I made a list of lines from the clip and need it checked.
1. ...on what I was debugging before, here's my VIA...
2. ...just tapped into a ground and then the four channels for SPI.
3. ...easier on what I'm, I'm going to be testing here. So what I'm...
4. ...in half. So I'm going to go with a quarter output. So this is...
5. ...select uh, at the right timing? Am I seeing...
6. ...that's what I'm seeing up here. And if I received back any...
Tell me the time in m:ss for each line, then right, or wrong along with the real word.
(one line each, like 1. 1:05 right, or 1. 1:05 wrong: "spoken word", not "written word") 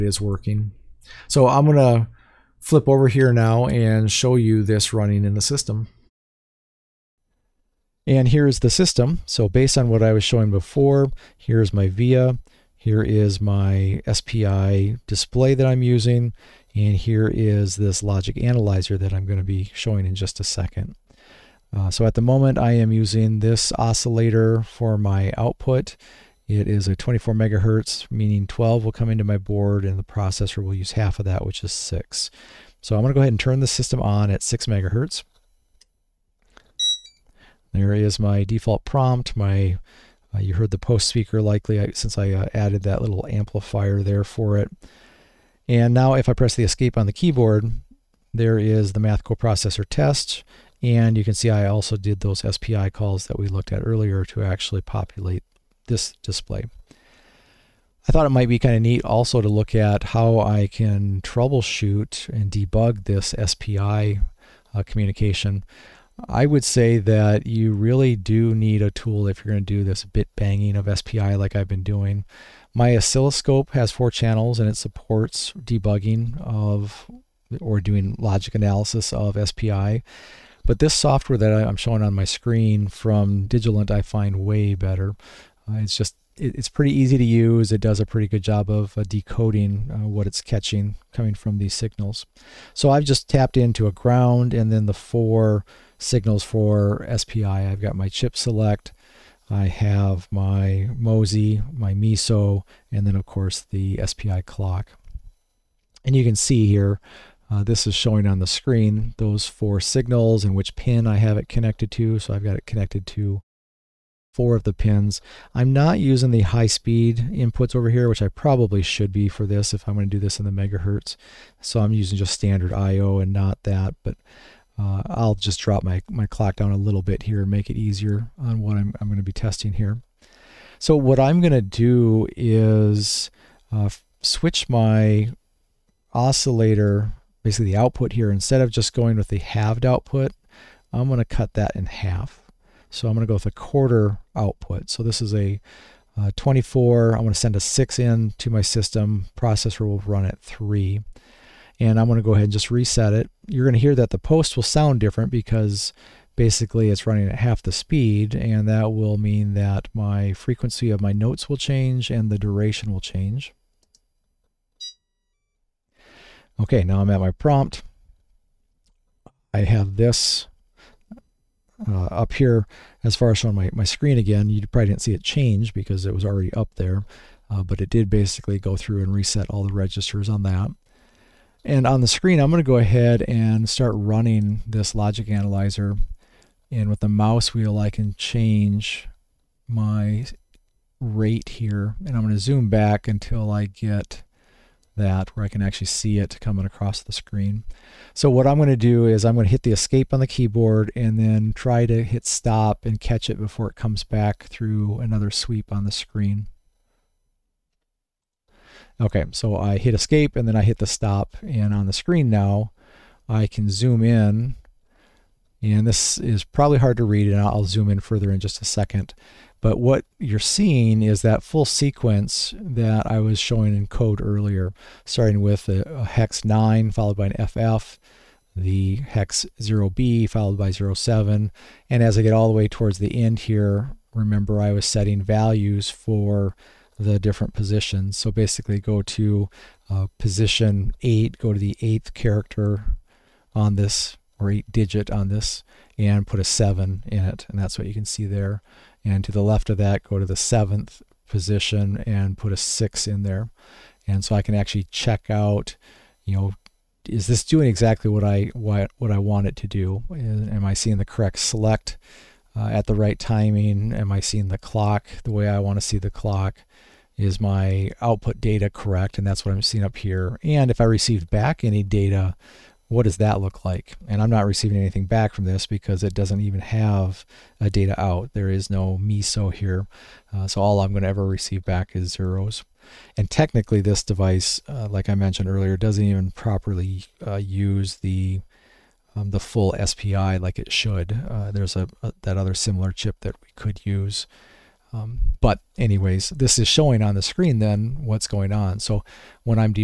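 1. 0:09 wrong: "showing", not "debugging"
2. 1:33 wrong: "signals", not "channels"
3. 2:07 right
4. 2:21 right
5. 4:21 right
6. 4:29 right.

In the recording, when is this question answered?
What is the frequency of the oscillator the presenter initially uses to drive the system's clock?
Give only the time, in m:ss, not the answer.
0:26.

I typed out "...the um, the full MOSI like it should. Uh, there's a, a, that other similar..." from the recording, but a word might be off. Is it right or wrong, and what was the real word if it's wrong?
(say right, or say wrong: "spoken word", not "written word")
wrong: "SPI", not "MOSI".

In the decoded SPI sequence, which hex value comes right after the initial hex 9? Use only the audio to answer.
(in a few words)
FF.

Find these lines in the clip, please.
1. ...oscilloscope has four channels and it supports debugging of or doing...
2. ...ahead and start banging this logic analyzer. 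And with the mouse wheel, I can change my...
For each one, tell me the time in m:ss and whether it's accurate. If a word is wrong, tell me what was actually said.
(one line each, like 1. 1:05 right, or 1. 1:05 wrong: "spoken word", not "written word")
1. 1:12 right
2. 3:02 wrong: "running", not "banging".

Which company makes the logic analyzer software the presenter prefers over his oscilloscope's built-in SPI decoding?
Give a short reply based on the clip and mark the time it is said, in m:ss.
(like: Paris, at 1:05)
Digilent, at 1:23.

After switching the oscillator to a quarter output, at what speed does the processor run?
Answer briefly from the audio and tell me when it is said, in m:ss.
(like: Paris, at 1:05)
3 MHz, at 2:30.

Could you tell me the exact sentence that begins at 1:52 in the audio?
So I've got it connected to four of the pins.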